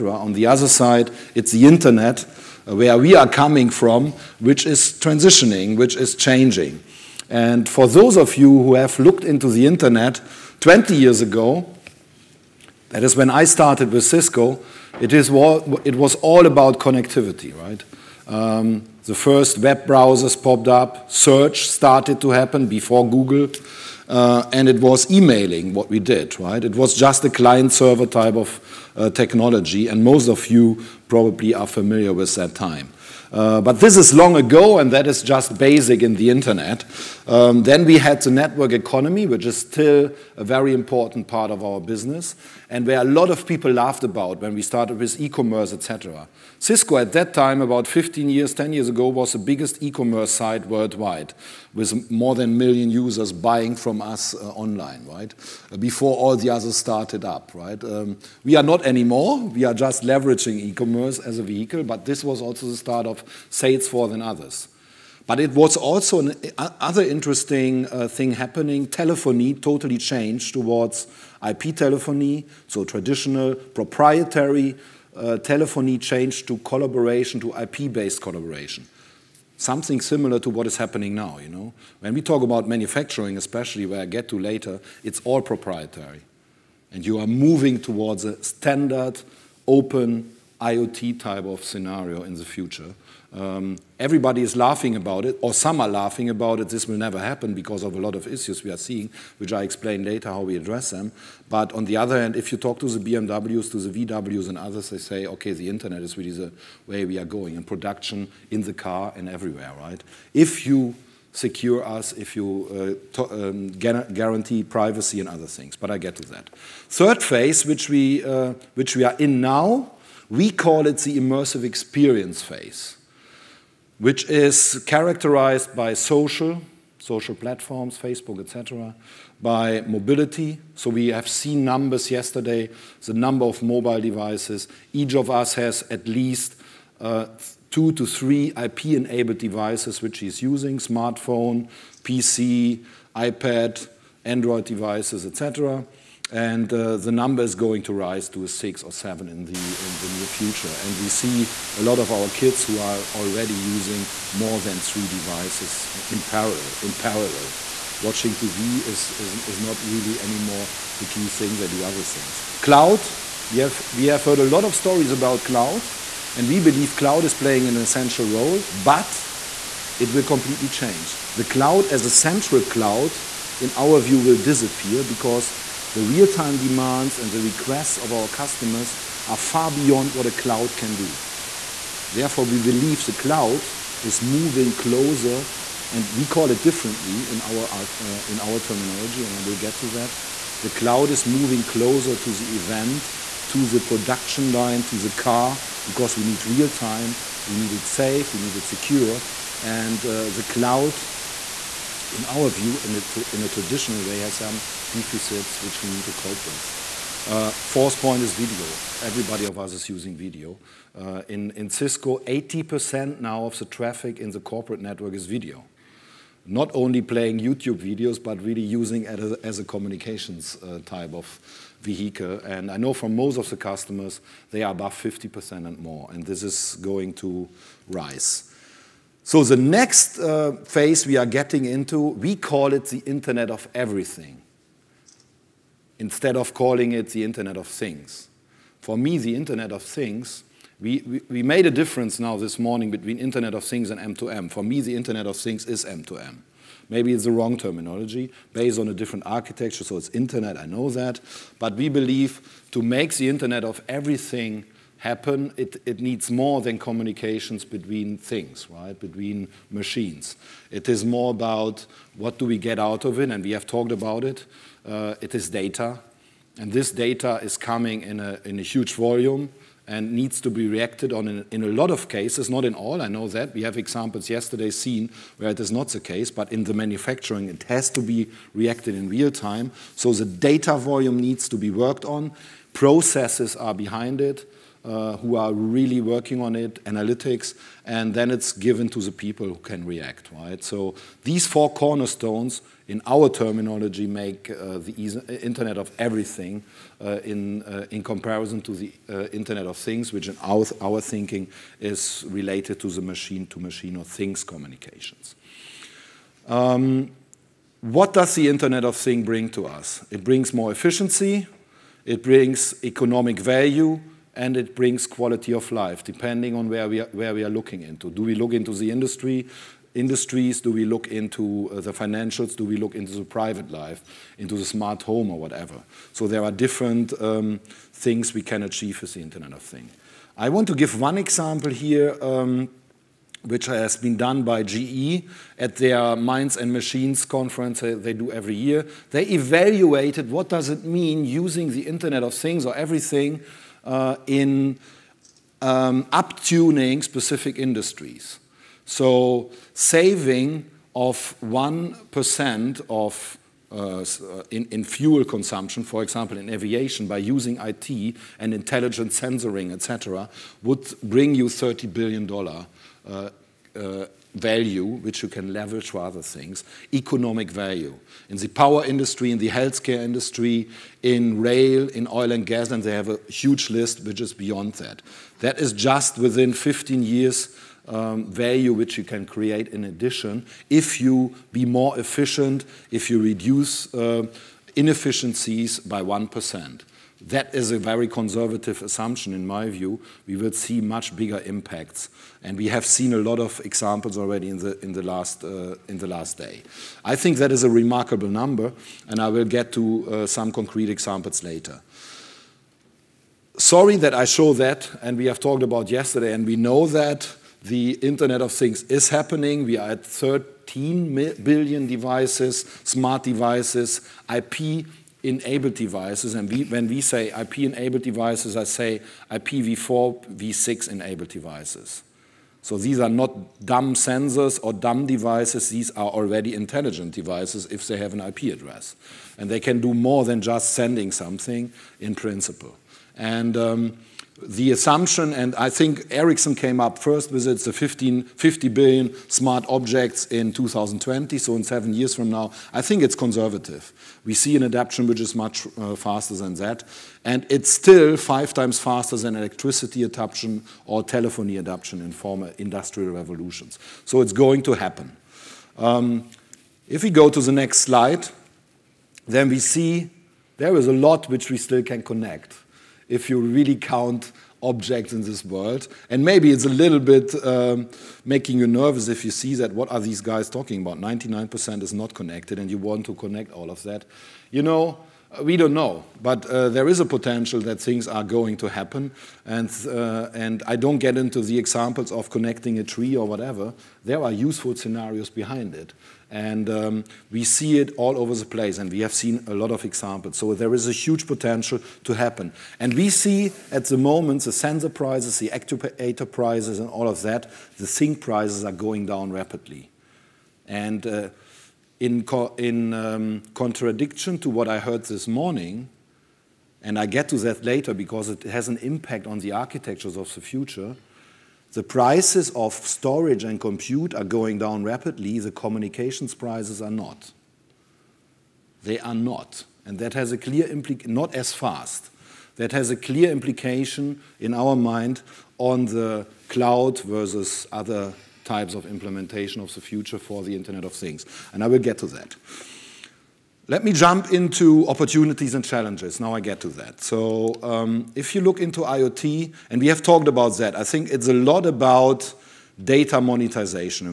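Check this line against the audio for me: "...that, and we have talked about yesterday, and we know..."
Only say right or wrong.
right.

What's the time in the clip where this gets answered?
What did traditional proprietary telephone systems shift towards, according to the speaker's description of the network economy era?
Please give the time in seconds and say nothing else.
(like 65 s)
71 s.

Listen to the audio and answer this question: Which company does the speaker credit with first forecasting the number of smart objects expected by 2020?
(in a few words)
Ericsson.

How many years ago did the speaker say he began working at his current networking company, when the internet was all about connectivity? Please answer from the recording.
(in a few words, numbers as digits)
20 years.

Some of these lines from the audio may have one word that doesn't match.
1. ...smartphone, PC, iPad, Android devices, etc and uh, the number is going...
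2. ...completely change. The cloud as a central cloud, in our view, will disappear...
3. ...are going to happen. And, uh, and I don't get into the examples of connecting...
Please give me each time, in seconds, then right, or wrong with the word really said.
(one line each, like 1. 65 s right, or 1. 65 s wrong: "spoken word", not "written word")
1. 140 s right
2. 170 s right
3. 478 s right.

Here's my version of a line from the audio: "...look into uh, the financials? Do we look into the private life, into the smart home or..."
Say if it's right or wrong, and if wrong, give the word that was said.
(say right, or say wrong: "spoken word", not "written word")
right.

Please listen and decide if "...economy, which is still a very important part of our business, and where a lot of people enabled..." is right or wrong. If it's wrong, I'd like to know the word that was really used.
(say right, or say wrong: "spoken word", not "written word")
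wrong: "laughed", not "enabled".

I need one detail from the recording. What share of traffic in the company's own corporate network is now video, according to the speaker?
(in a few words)
80%.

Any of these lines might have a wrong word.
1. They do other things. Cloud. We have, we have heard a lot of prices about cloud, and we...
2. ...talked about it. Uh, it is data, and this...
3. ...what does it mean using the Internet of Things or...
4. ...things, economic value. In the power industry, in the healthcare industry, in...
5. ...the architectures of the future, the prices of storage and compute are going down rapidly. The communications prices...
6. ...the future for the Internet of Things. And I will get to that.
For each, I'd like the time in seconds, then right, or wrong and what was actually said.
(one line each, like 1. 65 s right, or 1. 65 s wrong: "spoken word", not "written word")
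1. 161 s wrong: "stories", not "prices"
2. 263 s right
3. 340 s right
4. 366 s right
5. 509 s right
6. 529 s right.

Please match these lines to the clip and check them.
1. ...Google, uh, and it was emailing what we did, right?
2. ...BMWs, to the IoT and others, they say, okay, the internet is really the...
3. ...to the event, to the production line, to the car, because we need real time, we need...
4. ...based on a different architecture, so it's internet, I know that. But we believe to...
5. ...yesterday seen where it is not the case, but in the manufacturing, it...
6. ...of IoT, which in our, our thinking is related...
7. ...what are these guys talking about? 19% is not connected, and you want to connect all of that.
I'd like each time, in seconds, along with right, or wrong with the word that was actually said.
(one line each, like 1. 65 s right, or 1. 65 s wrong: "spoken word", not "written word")
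1. 23 s right
2. 102 s wrong: "VWs", not "IoT"
3. 192 s right
4. 248 s right
5. 274 s right
6. 299 s wrong: "Things", not "IoT"
7. 469 s wrong: "99", not "19".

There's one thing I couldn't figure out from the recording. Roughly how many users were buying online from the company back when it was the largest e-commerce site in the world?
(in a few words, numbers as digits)
more than a million.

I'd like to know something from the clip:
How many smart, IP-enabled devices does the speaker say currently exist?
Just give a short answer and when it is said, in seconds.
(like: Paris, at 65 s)
13 billion, at 410 s.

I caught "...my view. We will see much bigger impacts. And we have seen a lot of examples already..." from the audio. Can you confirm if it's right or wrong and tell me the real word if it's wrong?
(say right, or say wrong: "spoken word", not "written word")
right.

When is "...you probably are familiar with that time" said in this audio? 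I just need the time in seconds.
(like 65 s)
30 s.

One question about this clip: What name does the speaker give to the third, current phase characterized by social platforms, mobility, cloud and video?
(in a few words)
immersive experience phase.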